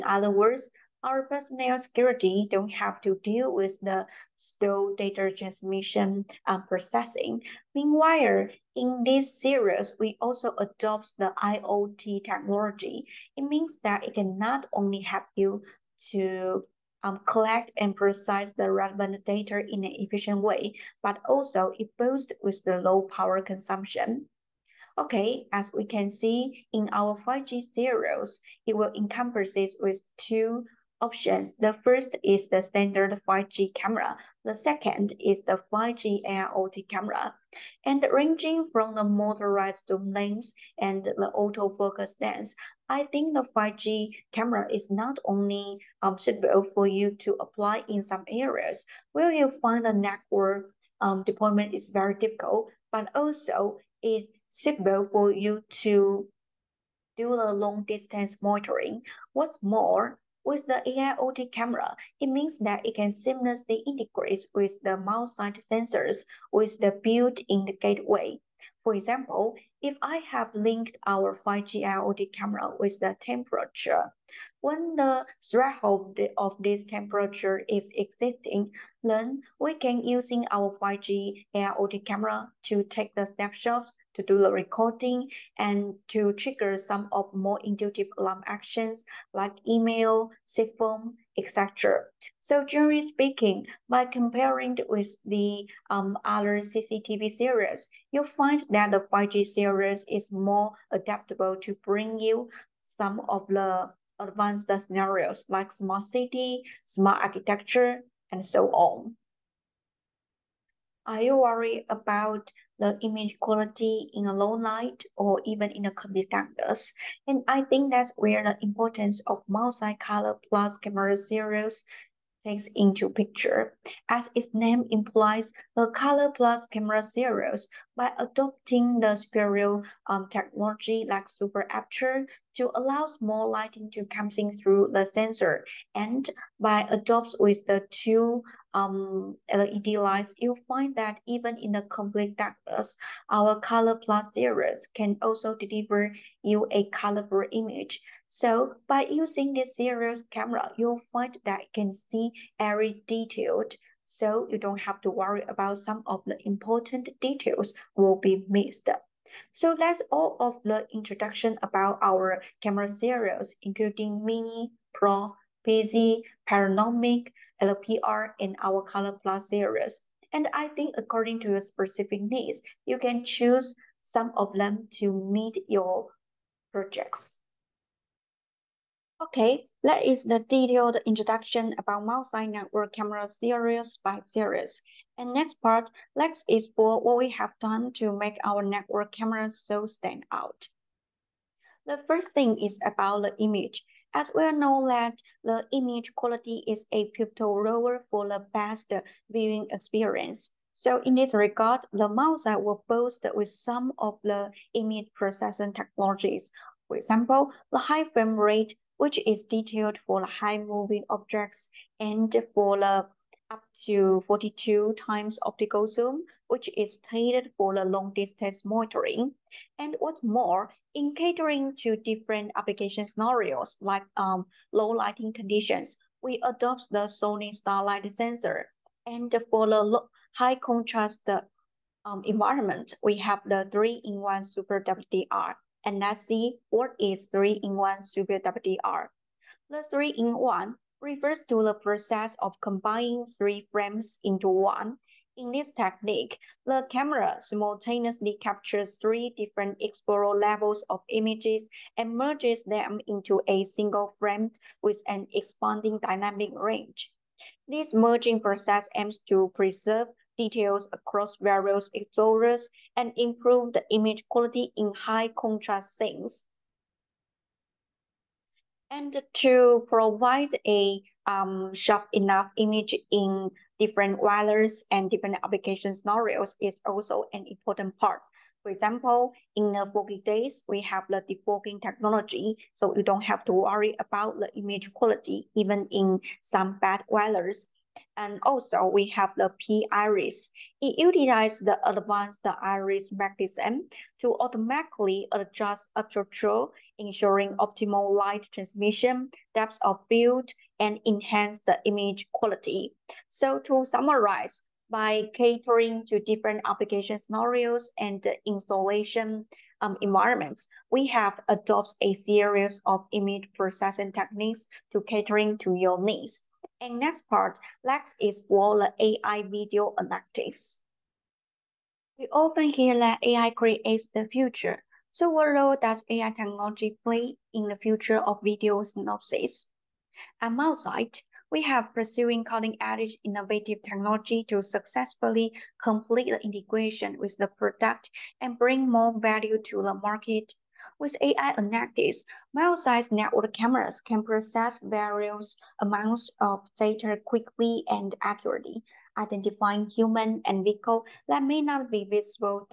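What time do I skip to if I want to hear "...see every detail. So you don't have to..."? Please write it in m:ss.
2:31.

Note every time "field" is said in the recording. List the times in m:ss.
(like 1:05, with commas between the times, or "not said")
5:00.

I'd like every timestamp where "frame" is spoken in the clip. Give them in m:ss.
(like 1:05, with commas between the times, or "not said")
3:28, 4:03, 4:14.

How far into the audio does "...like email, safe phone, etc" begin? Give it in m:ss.
1:29.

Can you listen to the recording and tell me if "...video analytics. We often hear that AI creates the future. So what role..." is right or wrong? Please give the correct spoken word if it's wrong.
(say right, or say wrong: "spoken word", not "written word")
right.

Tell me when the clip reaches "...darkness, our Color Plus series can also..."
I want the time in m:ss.
2:22.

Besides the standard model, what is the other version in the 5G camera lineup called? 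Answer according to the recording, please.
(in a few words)
5G AIoT camera.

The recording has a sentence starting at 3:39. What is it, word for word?
And what's more, in catering to different application scenarios like um, low lighting conditions, we adopt the Sony Starlight sensor.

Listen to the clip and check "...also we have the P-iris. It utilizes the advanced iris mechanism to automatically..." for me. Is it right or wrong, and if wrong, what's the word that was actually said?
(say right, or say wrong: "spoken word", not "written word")
right.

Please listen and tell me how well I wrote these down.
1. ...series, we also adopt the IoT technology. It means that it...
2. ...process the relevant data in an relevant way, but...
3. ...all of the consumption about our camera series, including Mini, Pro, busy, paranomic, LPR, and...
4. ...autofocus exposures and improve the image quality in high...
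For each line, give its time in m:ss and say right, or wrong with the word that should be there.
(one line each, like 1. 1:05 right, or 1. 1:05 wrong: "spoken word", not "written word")
1. 0:09 right
2. 0:17 wrong: "efficient", not "relevant"
3. 2:40 wrong: "introduction", not "consumption"
4. 4:21 wrong: "various", not "autofocus".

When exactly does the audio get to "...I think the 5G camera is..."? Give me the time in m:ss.
0:42.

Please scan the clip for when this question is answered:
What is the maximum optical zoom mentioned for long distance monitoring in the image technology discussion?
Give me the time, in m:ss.
3:34.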